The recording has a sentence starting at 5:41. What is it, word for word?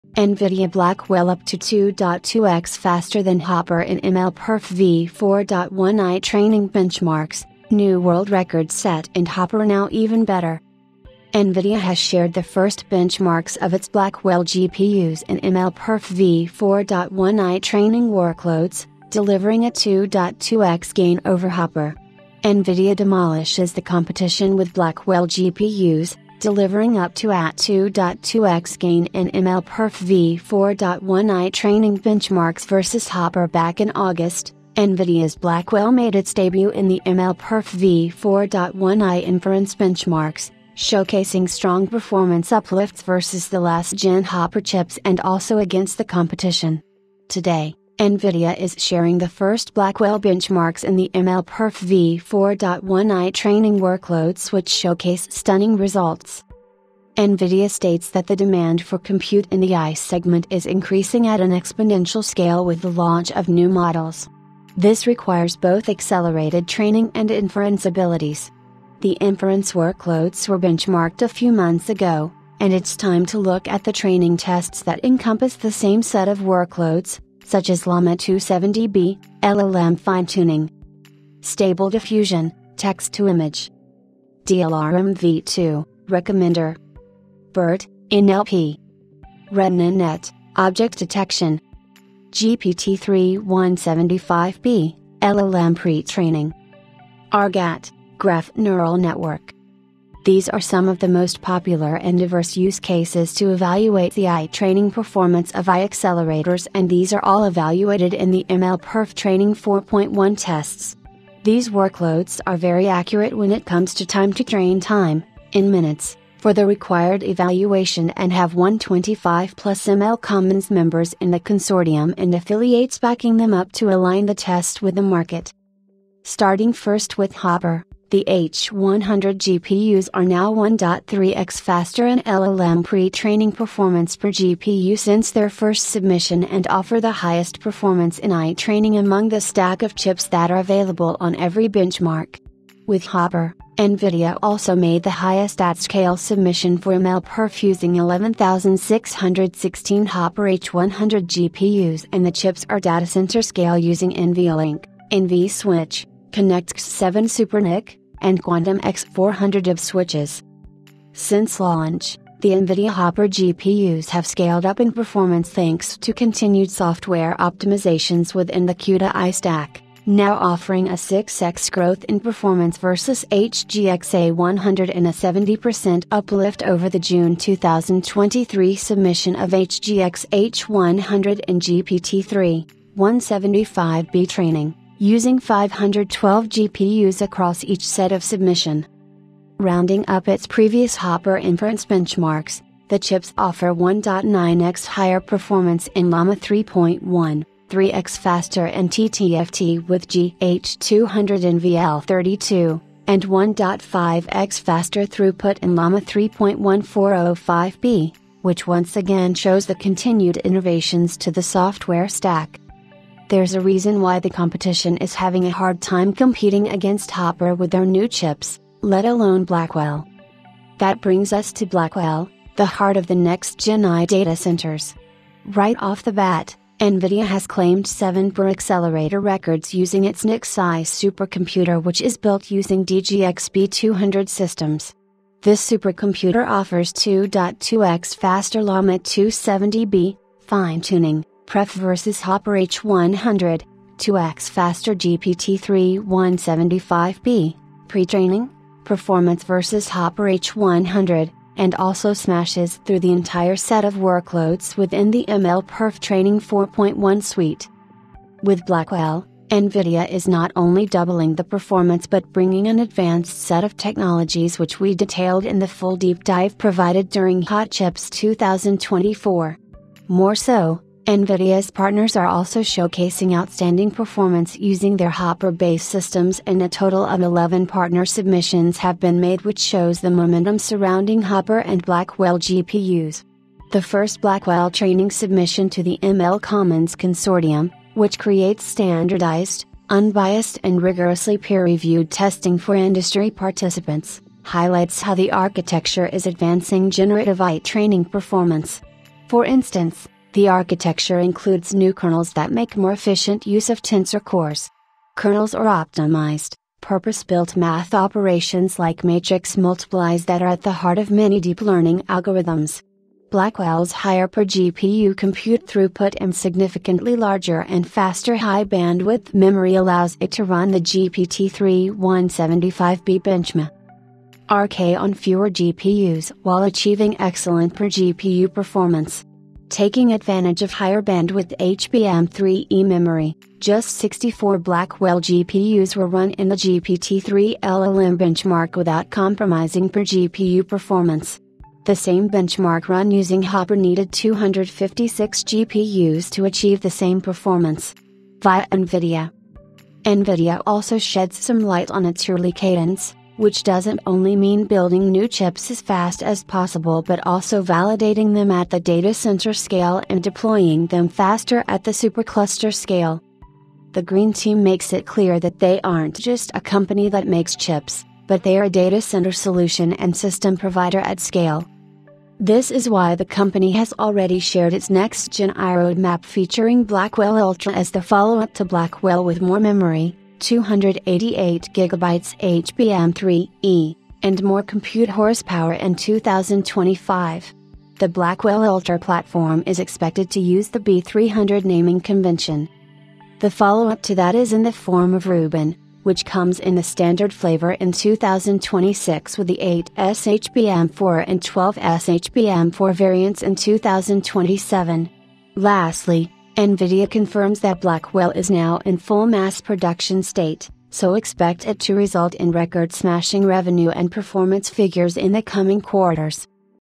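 The same benchmark run using Hopper needed 256 GPUs to achieve the same performance.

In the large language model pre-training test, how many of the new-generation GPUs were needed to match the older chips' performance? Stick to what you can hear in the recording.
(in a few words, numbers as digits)
64.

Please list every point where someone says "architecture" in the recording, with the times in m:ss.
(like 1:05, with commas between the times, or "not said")
4:55, 5:00.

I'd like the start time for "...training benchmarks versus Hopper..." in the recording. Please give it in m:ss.
0:31.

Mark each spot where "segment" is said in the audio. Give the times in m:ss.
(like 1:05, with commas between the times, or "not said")
0:59.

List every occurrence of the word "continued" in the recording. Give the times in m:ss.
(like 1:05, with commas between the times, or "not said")
2:46, 3:29.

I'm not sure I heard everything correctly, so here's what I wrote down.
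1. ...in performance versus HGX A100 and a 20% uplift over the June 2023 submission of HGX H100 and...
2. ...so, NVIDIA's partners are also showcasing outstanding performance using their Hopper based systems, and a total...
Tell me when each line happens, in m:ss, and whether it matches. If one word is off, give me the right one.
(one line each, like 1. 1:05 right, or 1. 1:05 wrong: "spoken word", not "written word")
1. 2:52 wrong: "70", not "20"
2. 4:30 right.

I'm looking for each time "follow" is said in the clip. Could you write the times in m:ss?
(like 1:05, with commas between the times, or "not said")
6:18, 6:33.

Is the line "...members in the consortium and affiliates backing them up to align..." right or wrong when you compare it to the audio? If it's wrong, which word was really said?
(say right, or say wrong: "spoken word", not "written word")
right.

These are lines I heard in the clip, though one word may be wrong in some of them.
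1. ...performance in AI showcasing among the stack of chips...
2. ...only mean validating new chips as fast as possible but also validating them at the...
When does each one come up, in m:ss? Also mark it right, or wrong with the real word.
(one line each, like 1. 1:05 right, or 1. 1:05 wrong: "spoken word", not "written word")
1. 2:17 wrong: "training", not "showcasing"
2. 5:54 wrong: "building", not "validating".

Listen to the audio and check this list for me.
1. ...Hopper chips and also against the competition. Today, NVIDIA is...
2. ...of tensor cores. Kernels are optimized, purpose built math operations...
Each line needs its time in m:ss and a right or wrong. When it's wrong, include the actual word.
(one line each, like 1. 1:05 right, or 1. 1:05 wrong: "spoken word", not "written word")
1. 0:44 right
2. 5:03 right.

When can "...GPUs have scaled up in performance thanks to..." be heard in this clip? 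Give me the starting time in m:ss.
2:43.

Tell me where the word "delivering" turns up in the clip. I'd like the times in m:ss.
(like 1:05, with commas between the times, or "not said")
0:19, 0:26.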